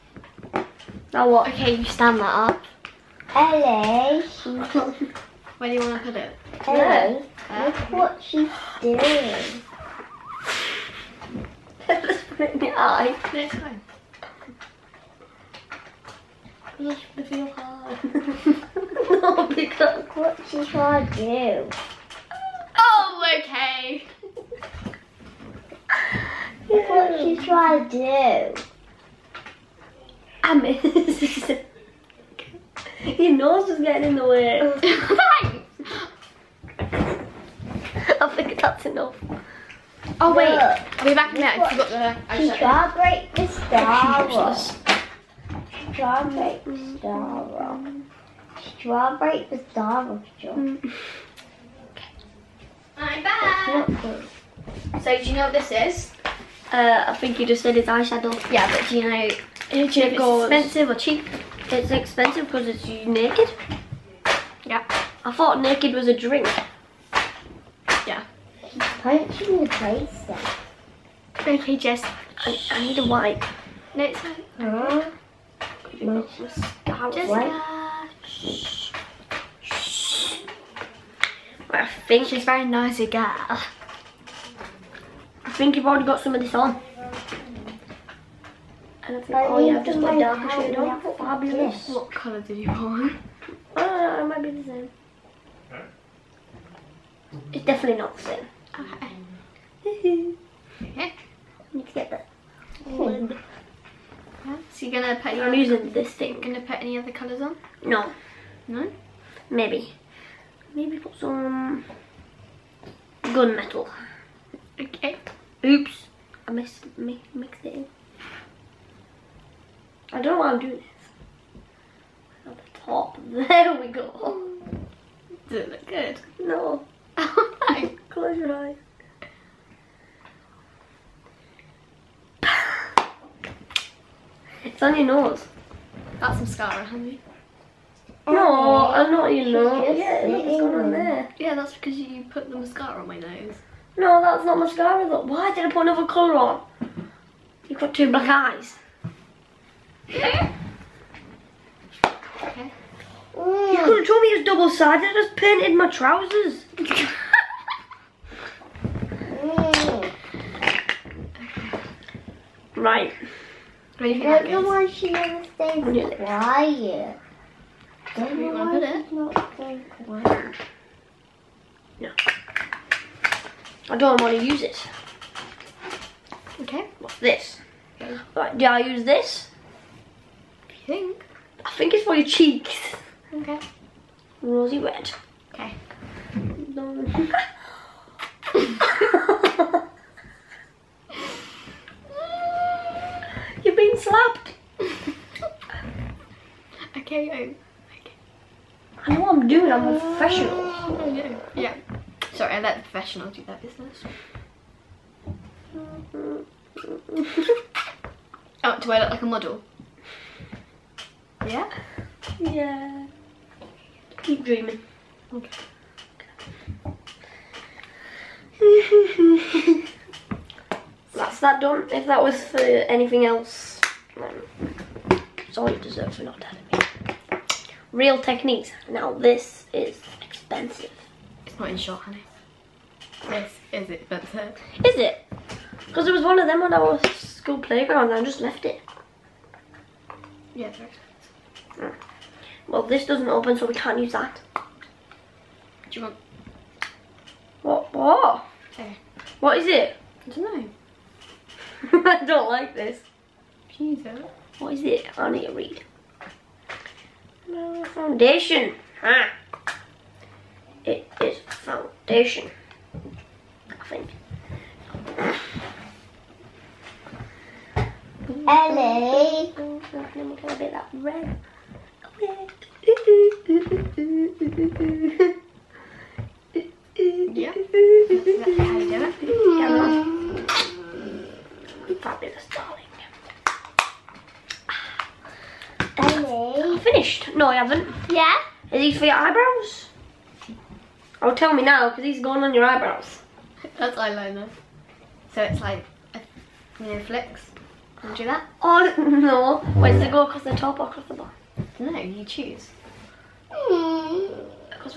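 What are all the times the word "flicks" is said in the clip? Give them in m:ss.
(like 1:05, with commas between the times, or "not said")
4:56.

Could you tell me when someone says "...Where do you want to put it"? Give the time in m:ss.
0:05.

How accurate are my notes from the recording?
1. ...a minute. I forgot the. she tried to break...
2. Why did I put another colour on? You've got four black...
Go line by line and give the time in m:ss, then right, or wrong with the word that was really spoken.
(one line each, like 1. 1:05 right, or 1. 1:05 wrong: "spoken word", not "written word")
1. 0:41 right
2. 2:25 wrong: "two", not "four".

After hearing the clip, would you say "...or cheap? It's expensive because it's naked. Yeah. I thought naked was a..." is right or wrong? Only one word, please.
right.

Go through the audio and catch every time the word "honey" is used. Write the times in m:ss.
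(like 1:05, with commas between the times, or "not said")
2:16, 3:51.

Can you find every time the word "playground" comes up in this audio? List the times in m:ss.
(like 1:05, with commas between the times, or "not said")
3:57.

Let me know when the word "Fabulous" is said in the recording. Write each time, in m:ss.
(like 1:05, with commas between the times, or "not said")
1:31, 4:42.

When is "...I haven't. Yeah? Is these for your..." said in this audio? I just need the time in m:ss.
4:47.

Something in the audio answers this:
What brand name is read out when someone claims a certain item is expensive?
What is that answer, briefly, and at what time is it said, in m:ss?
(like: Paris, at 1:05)
Real Techniques, at 3:47.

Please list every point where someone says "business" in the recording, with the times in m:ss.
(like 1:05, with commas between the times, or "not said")
3:23.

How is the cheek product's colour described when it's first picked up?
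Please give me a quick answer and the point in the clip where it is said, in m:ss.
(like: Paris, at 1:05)
Rosy red, at 3:04.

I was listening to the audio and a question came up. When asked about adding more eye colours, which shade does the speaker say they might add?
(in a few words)
Gunmetal.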